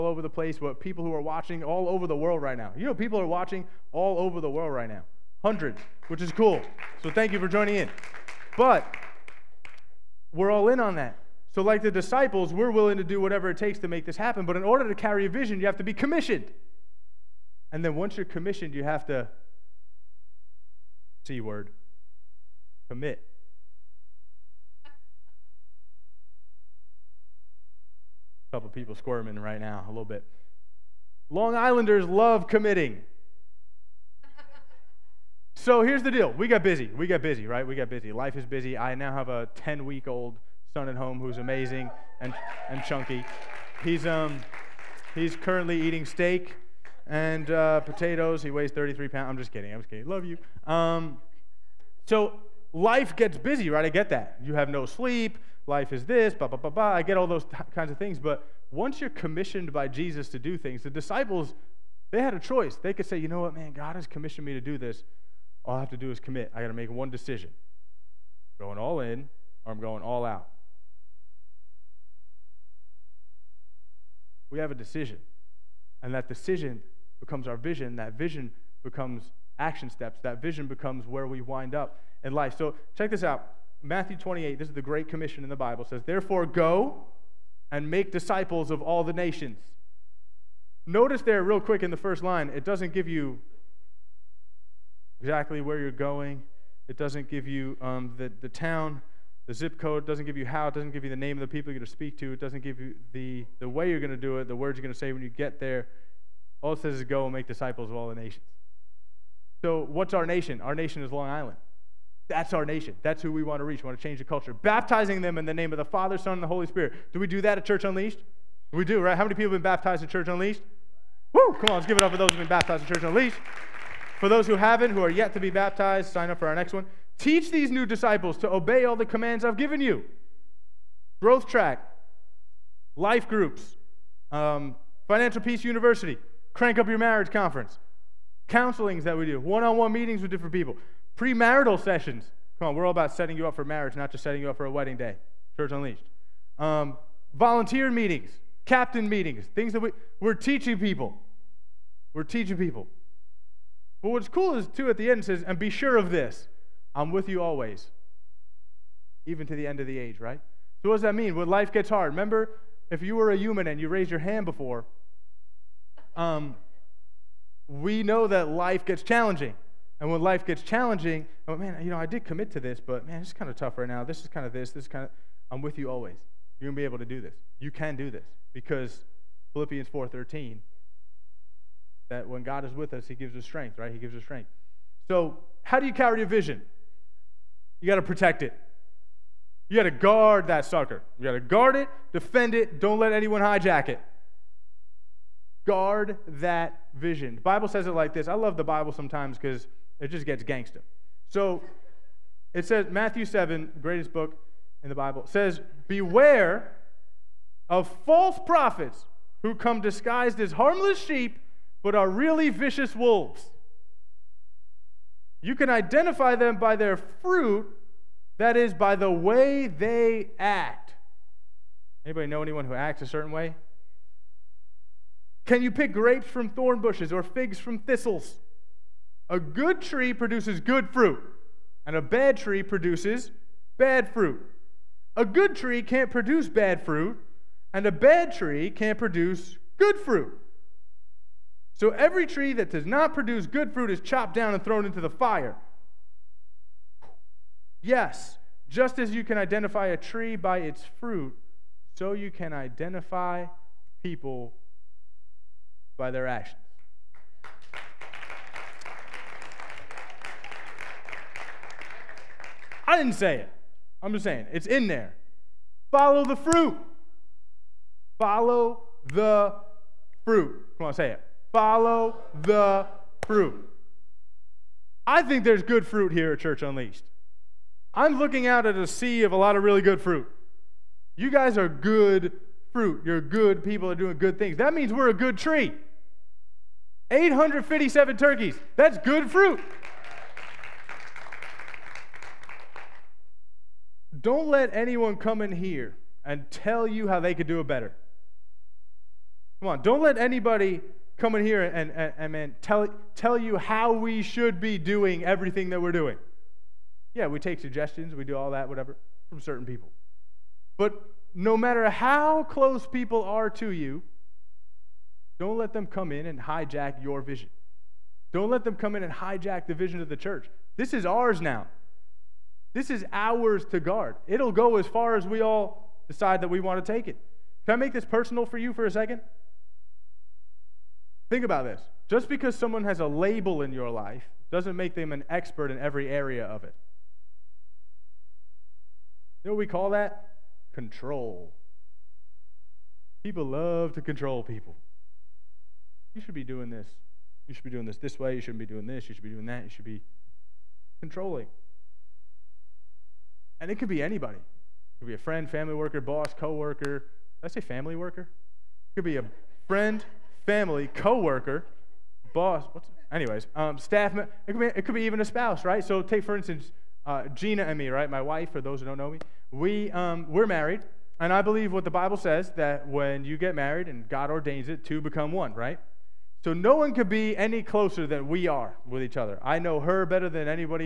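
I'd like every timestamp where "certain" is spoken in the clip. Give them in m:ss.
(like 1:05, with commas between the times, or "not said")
3:43, 5:09.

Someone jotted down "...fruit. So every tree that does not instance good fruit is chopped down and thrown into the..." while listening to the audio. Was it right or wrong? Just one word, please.
wrong.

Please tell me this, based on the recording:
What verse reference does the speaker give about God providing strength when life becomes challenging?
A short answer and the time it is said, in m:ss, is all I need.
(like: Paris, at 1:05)
Philippians 4:13, at 2:59.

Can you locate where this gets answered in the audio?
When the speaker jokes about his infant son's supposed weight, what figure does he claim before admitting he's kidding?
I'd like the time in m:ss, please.
0:48.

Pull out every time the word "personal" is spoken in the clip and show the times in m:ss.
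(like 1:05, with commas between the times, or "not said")
5:28.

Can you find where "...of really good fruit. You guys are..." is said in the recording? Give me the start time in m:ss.
4:39.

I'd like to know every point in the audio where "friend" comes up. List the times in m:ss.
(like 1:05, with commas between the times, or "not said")
5:55, 5:59.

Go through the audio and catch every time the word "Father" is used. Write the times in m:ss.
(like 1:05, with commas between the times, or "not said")
1:55.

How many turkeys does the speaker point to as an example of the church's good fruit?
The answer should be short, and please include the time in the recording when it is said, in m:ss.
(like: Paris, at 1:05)
857, at 4:47.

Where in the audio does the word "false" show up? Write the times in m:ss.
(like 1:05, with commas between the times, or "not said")
3:28.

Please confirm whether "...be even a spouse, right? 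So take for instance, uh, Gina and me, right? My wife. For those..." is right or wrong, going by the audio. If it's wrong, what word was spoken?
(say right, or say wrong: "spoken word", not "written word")
right.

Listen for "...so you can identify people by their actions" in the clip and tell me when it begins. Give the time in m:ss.
4:11.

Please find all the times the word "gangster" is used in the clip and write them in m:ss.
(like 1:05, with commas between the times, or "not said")
3:20.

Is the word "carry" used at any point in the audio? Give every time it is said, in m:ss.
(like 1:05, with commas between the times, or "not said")
0:14, 3:05.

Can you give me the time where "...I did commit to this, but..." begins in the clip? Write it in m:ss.
2:51.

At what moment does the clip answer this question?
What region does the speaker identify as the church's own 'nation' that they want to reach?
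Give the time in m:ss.
1:51.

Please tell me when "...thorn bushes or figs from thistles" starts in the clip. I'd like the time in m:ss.
3:46.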